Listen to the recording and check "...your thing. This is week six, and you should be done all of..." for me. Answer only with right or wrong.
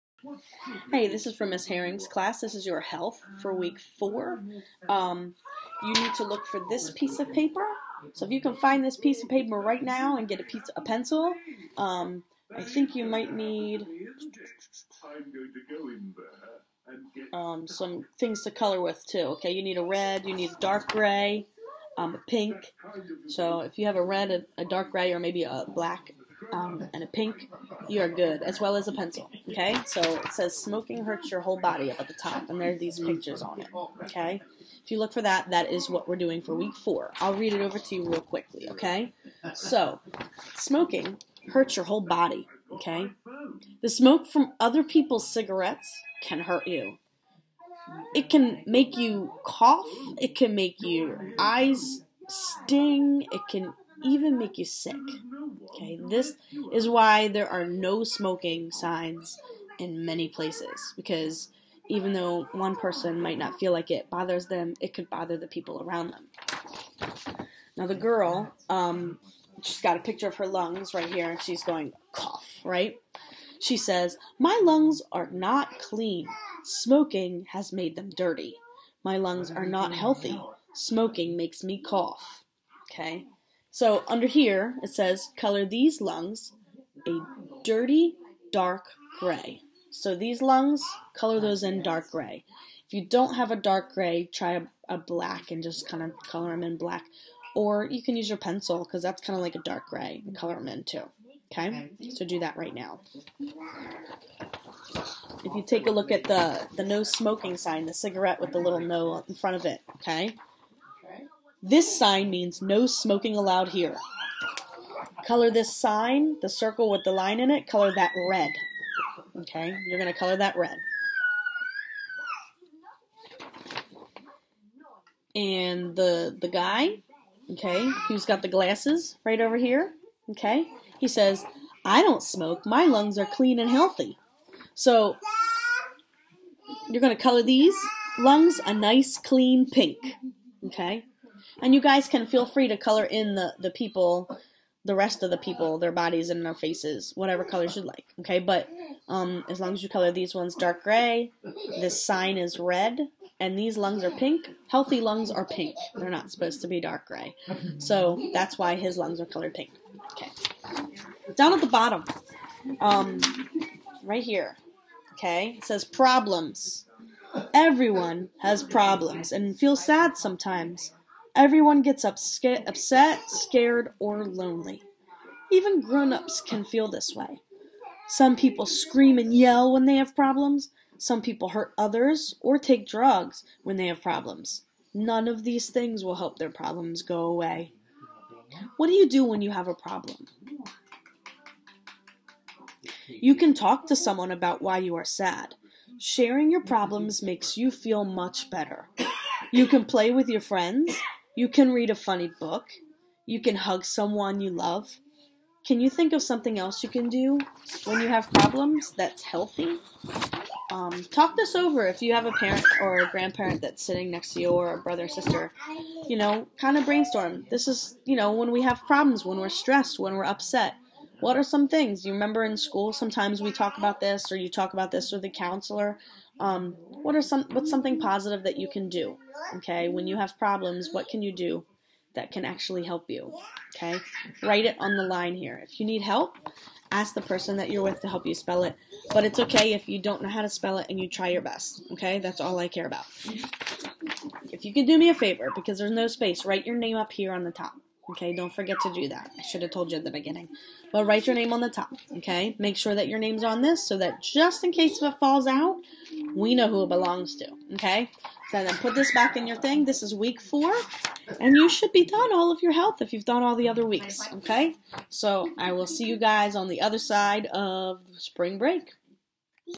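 wrong.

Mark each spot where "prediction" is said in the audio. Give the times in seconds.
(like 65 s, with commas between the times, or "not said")
not said.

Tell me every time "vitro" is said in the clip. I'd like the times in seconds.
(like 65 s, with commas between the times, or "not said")
not said.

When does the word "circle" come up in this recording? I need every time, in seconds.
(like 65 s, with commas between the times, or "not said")
116 s.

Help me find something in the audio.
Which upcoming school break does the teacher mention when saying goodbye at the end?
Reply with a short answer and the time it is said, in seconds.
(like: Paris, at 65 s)
Spring break, at 268 s.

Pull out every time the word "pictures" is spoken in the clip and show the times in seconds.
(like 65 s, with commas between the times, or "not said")
32 s, 70 s.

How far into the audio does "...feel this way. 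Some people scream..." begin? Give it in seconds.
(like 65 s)
176 s.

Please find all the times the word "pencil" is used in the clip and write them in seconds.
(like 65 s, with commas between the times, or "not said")
10 s, 28 s, 98 s.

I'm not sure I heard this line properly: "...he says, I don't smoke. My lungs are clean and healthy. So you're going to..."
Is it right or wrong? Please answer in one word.
right.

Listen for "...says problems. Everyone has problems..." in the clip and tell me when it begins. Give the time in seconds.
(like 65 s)
165 s.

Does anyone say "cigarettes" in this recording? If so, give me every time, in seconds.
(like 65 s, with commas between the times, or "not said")
45 s, 107 s.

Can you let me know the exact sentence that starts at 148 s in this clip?
But um, as long as you color these ones dark gray, this sign is red, and these lungs are pink.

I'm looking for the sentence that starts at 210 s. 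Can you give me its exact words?
Um, talk this over if you have a parent or a grandparent that's sitting next to you or a brother or sister.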